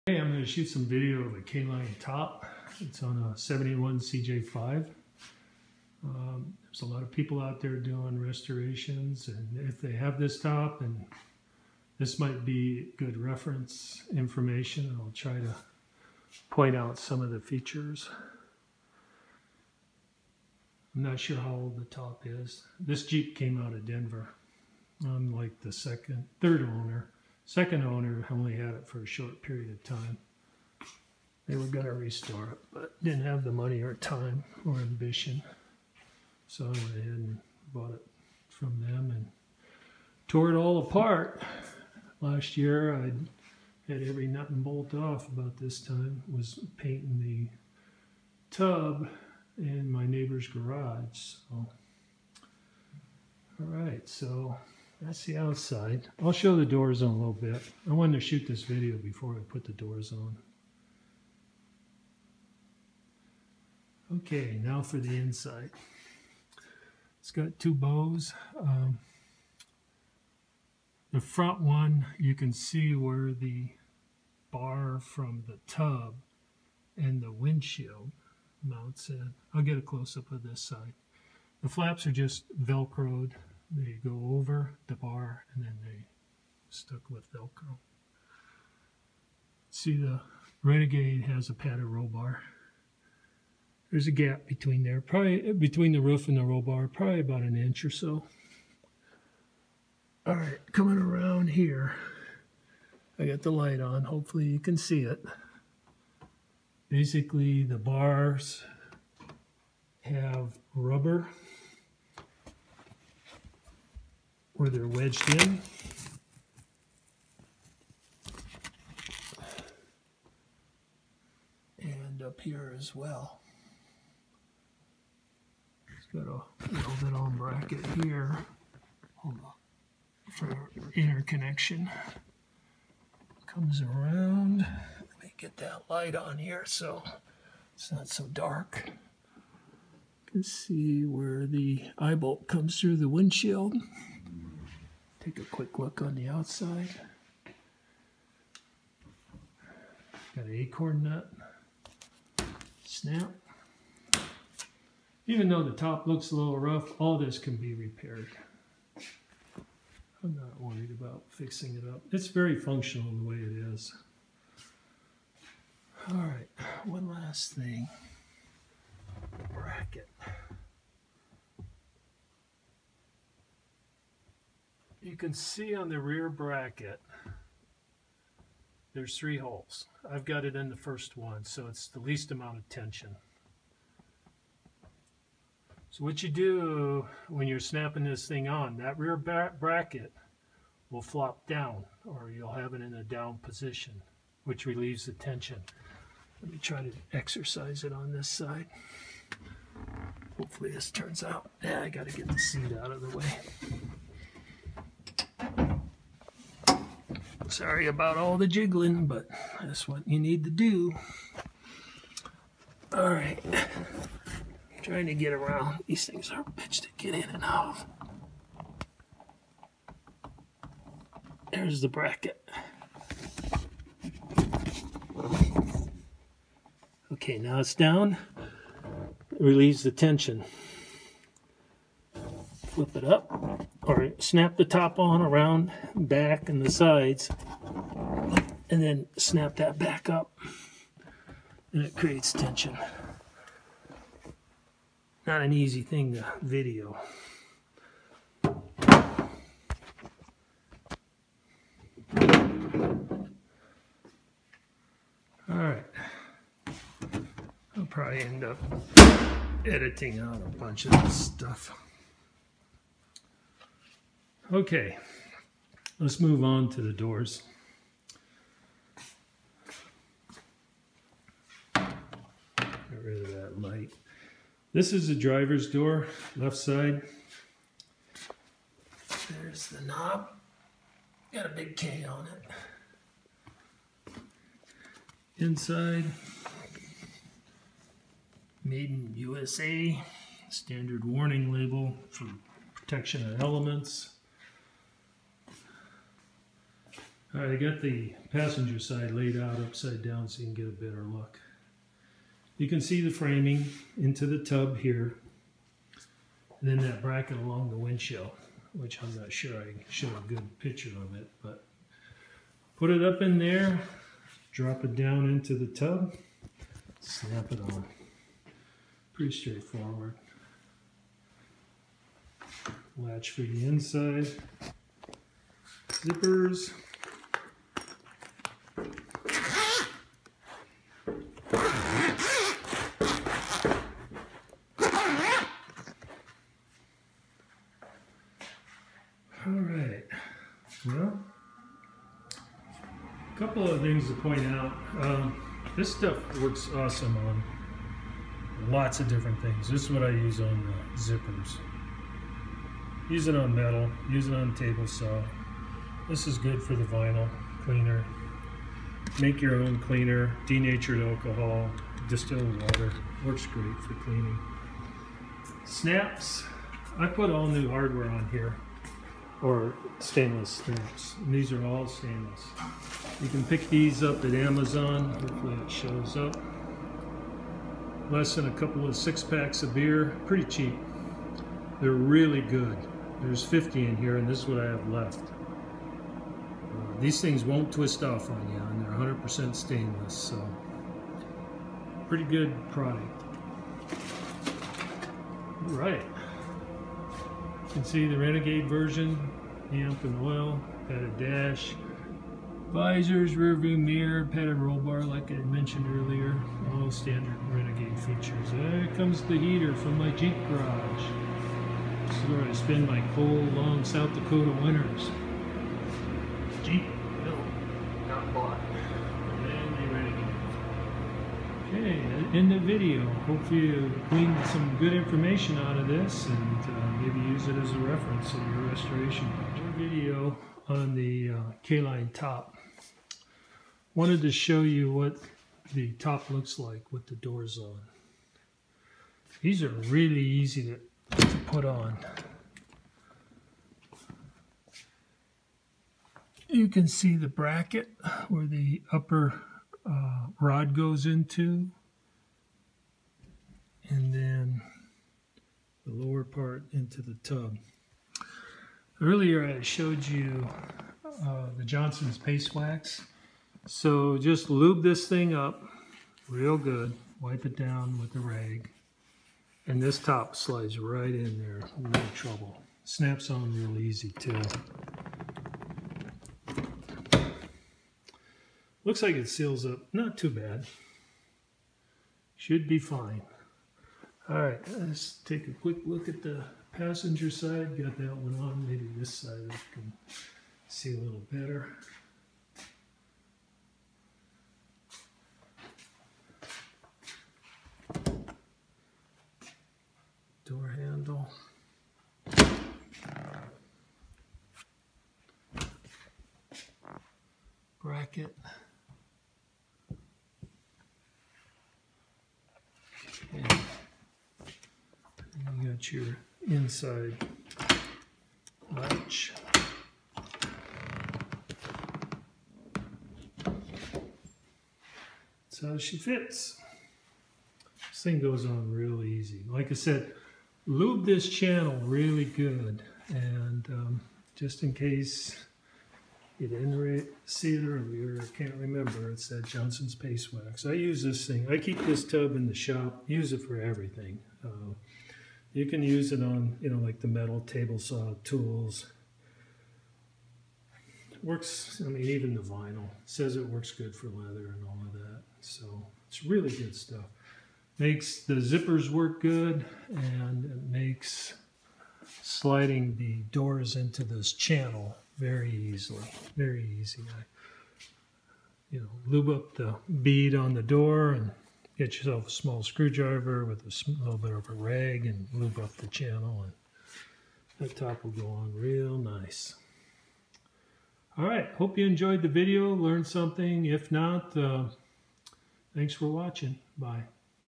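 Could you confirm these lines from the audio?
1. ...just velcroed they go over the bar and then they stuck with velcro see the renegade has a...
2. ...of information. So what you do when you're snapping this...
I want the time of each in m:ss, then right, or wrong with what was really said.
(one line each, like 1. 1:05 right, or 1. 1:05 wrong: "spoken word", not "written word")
1. 1:22 right
2. 3:02 wrong: "tension", not "information".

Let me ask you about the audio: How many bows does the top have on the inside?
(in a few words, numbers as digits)
2.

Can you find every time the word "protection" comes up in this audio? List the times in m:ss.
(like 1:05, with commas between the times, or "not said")
4:52.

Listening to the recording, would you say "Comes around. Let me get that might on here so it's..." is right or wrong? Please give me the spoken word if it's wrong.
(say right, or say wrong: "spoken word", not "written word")
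wrong: "light", not "might".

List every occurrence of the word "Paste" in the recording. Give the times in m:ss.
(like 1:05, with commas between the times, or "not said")
7:42, 8:59.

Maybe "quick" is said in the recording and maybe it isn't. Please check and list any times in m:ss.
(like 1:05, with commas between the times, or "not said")
2:25, 8:05.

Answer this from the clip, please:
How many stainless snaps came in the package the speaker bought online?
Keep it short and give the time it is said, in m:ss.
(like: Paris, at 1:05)
50, at 6:23.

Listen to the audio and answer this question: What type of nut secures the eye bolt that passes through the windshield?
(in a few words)
Acorn nut.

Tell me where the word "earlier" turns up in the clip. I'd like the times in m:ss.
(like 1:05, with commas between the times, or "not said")
6:45, 7:39, 8:57.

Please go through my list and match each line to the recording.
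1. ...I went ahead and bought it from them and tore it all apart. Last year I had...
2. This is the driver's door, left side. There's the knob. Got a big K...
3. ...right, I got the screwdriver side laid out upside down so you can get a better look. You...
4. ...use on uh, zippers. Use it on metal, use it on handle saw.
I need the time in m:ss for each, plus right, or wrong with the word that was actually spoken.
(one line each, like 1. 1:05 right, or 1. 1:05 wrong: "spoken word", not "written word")
1. 0:36 right
2. 4:34 right
3. 4:57 wrong: "passenger", not "screwdriver"
4. 5:50 wrong: "table", not "handle".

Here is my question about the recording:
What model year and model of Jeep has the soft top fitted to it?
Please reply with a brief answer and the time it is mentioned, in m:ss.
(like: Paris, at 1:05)
71 CJ5, at 0:03.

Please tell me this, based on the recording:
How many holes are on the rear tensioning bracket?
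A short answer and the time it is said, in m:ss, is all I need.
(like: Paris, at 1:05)
3, at 2:59.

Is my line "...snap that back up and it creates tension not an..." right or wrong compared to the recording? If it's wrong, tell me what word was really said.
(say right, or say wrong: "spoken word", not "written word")
right.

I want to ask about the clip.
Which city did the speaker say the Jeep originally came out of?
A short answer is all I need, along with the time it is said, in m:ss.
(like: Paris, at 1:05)
Denver, at 0:23.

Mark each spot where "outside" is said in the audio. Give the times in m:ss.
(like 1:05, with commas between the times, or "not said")
0:55, 2:26.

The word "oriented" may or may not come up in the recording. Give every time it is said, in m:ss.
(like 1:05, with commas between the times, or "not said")
not said.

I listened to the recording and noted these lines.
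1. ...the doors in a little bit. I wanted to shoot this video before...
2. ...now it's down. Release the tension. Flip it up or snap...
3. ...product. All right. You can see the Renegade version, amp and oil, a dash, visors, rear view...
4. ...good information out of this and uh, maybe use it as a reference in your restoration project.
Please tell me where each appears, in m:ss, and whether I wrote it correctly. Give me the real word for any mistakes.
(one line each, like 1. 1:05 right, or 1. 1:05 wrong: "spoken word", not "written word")
1. 0:56 right
2. 3:47 right
3. 6:32 right
4. 7:04 right.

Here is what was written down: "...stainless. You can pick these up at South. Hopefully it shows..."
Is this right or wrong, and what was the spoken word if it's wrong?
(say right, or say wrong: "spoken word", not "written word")
wrong: "Amazon", not "South".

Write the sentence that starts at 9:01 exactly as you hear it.
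I keep this tub in the shop, use it for everything.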